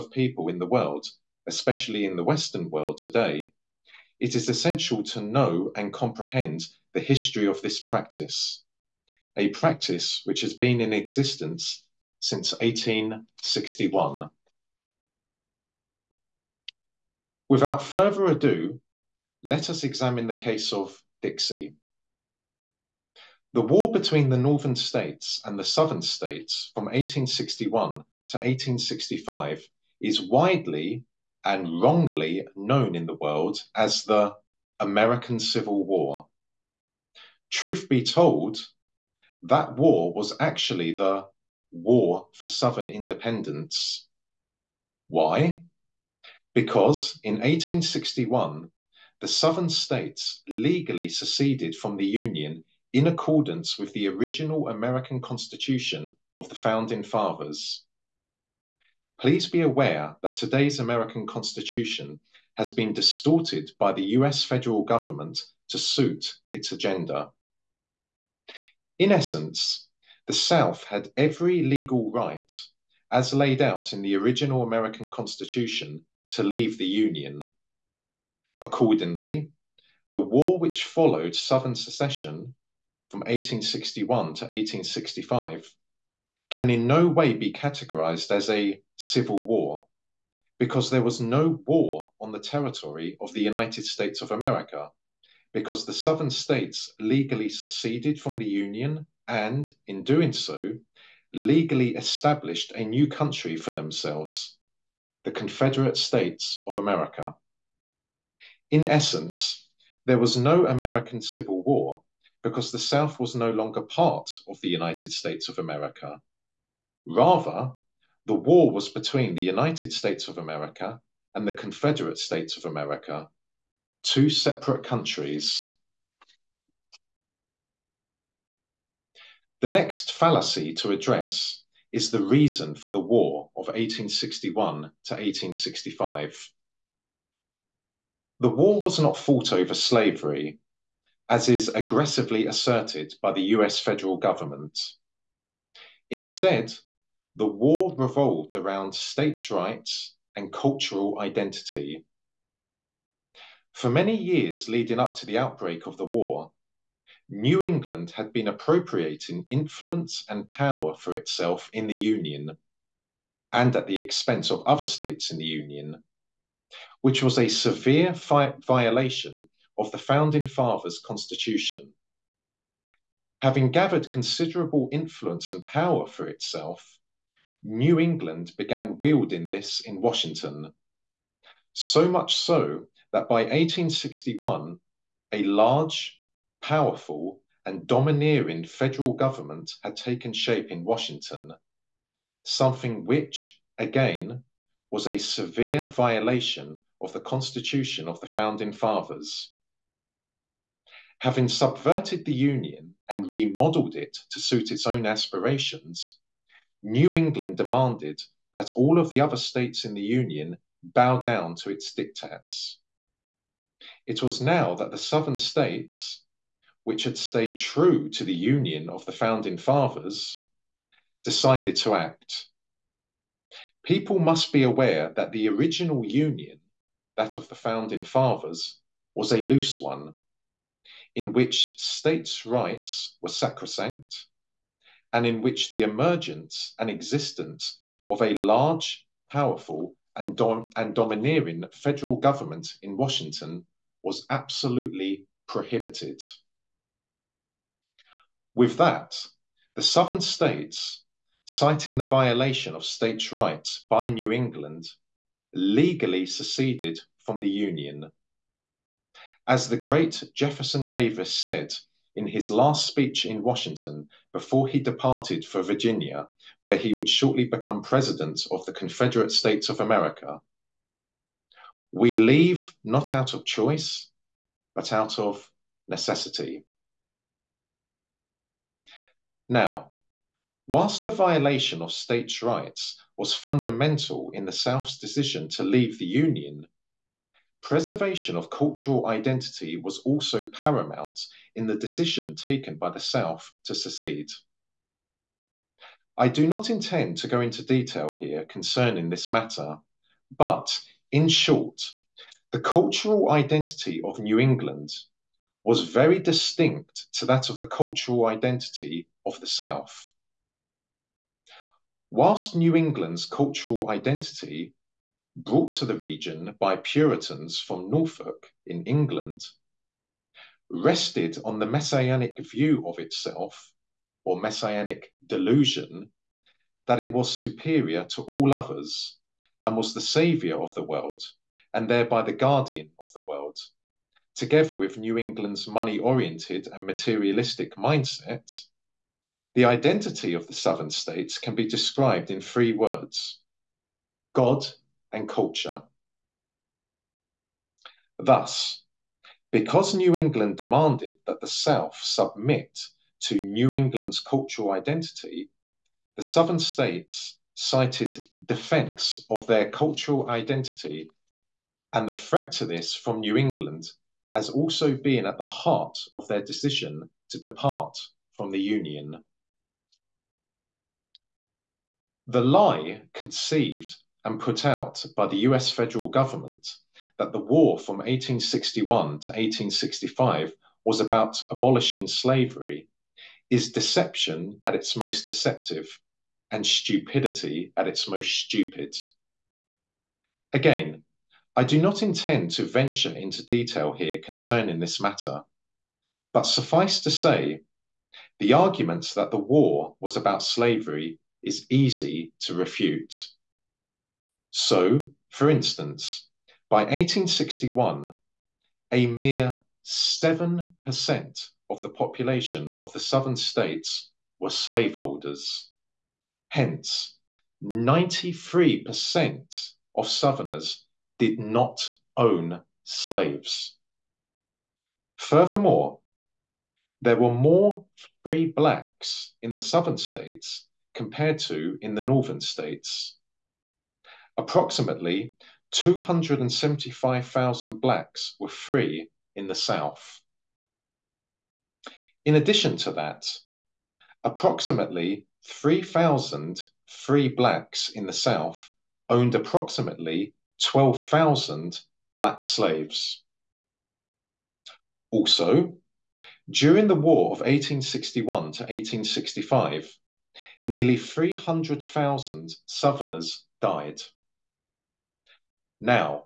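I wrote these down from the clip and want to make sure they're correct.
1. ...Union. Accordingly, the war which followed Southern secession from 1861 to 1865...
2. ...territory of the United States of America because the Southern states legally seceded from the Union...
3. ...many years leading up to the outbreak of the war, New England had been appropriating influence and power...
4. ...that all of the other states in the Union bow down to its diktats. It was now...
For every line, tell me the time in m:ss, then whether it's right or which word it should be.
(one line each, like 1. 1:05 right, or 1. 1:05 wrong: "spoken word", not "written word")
1. 1:16 right
2. 1:32 right
3. 2:33 right
4. 3:28 right.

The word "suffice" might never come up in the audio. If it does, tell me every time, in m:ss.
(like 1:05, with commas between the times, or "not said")
6:36.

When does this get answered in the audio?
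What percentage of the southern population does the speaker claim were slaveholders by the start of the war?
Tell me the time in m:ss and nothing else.
6:49.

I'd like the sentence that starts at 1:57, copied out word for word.
Rather, the war was between the United States of America and the Confederate States of America, two separate countries.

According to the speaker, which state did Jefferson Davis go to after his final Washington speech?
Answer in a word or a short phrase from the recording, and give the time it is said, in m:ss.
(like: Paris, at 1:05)
Virginia, at 4:25.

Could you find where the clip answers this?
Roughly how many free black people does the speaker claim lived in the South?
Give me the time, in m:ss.
7:15.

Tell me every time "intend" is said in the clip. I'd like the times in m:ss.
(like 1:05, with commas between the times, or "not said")
4:56, 6:32.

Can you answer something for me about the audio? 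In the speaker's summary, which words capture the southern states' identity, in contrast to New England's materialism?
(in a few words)
God and culture.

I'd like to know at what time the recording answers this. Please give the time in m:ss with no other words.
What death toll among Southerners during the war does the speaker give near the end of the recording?
7:40.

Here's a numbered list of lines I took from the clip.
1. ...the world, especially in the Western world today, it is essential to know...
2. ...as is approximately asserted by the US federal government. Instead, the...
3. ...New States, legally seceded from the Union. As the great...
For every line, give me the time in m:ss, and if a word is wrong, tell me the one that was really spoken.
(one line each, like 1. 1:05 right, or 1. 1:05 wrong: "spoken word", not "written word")
1. 0:00 right
2. 2:21 wrong: "aggressively", not "approximately"
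3. 4:14 wrong: "England", not "States".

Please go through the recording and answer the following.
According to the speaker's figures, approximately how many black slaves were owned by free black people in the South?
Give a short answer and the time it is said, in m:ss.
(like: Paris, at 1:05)
12,000, at 7:30.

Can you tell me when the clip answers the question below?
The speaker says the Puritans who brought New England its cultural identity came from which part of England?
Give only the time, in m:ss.
5:17.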